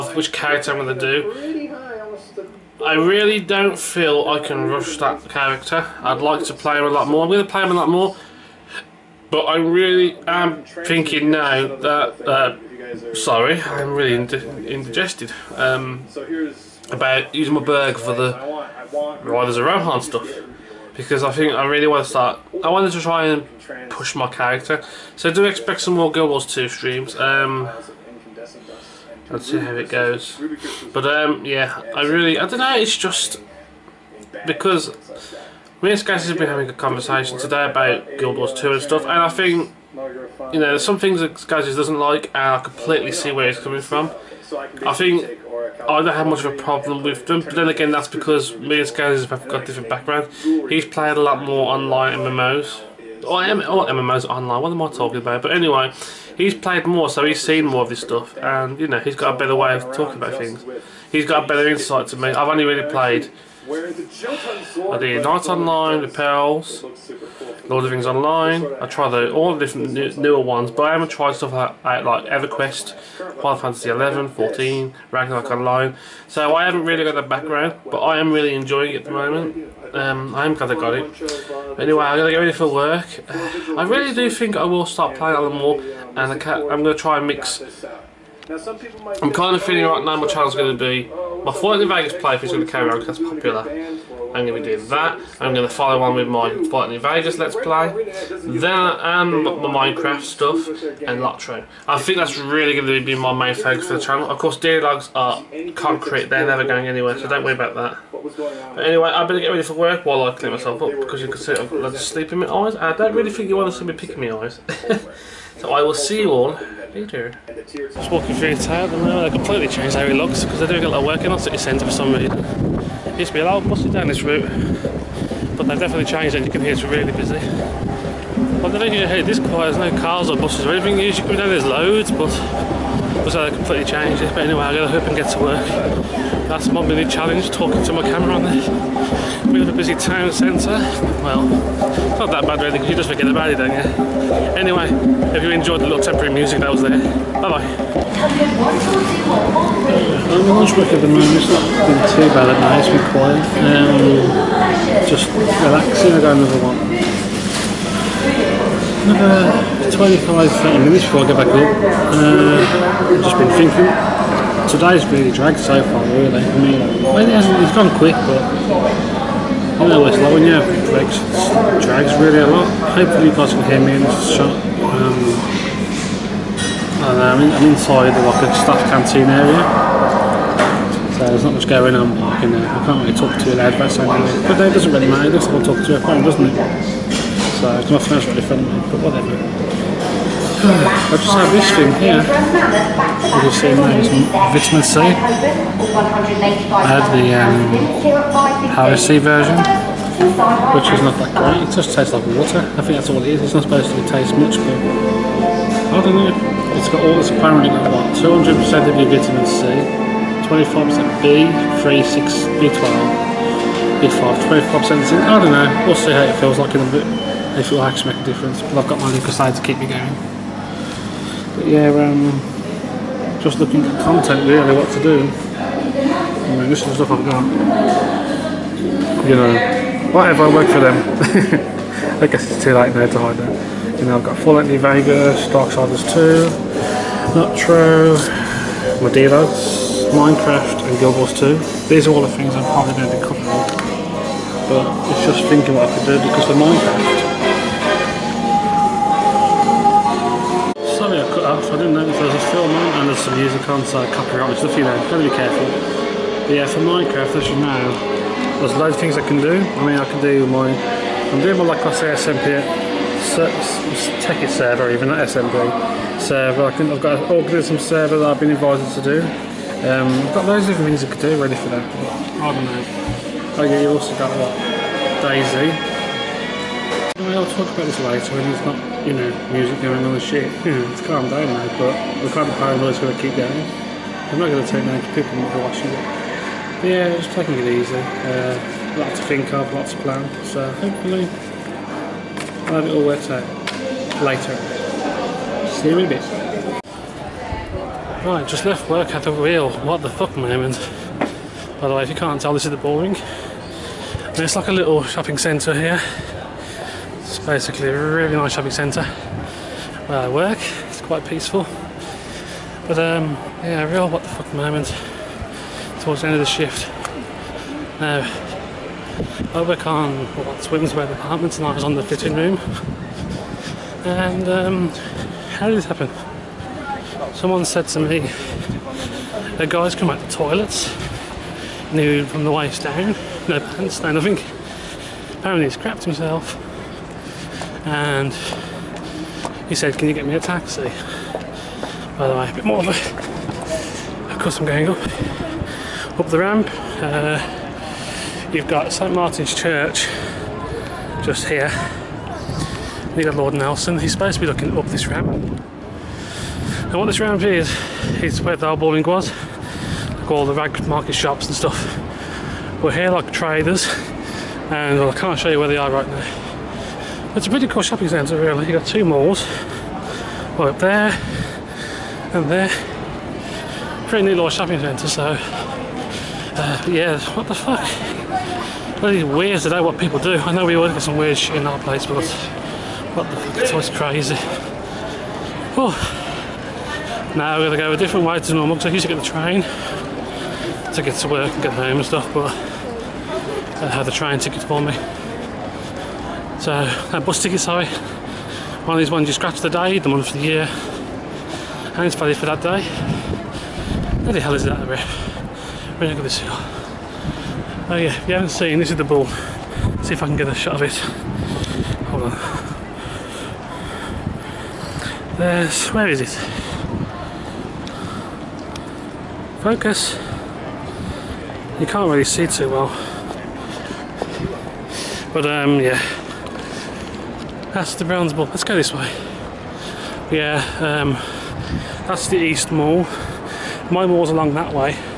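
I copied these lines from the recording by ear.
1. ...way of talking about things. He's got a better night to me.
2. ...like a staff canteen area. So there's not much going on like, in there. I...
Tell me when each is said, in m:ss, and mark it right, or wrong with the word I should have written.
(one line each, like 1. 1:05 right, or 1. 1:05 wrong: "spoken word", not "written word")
1. 0:59 wrong: "insight", not "night"
2. 2:58 right.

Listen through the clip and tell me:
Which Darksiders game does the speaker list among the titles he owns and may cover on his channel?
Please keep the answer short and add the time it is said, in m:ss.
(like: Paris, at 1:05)
Darksiders 2, at 3:55.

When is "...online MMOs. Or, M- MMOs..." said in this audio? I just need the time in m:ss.
0:51.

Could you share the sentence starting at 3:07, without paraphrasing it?
So it's my phone's really friendly, but whatever.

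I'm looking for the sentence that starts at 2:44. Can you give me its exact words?
Today's really dragged so far, really.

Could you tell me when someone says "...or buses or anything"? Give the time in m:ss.
2:10.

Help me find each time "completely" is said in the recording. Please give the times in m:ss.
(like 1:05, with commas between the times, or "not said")
0:42, 1:59, 2:13.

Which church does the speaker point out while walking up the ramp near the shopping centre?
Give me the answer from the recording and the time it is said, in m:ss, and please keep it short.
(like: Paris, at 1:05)
St Martin's Church, at 5:48.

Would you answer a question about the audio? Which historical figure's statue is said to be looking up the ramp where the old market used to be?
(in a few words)
Lord Nelson.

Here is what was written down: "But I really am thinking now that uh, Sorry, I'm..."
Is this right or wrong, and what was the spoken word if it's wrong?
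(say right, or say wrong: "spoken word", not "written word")
right.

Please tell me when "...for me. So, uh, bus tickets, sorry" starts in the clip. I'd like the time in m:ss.
6:34.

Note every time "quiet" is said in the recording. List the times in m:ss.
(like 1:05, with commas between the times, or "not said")
2:09, 2:33.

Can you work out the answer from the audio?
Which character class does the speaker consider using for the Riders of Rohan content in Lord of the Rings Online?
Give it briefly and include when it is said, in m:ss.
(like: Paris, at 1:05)
burglar, at 0:17.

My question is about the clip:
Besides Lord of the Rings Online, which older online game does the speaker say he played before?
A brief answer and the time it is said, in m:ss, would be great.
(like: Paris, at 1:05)
Knights Online, at 1:05.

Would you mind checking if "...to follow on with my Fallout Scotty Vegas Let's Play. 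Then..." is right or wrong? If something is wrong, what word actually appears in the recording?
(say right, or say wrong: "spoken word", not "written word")
wrong: "New", not "Scotty".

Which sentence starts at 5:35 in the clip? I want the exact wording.
Apparently he's crapped himself and he said, can you get me a taxi?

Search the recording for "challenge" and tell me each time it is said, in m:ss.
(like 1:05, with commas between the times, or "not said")
2:17.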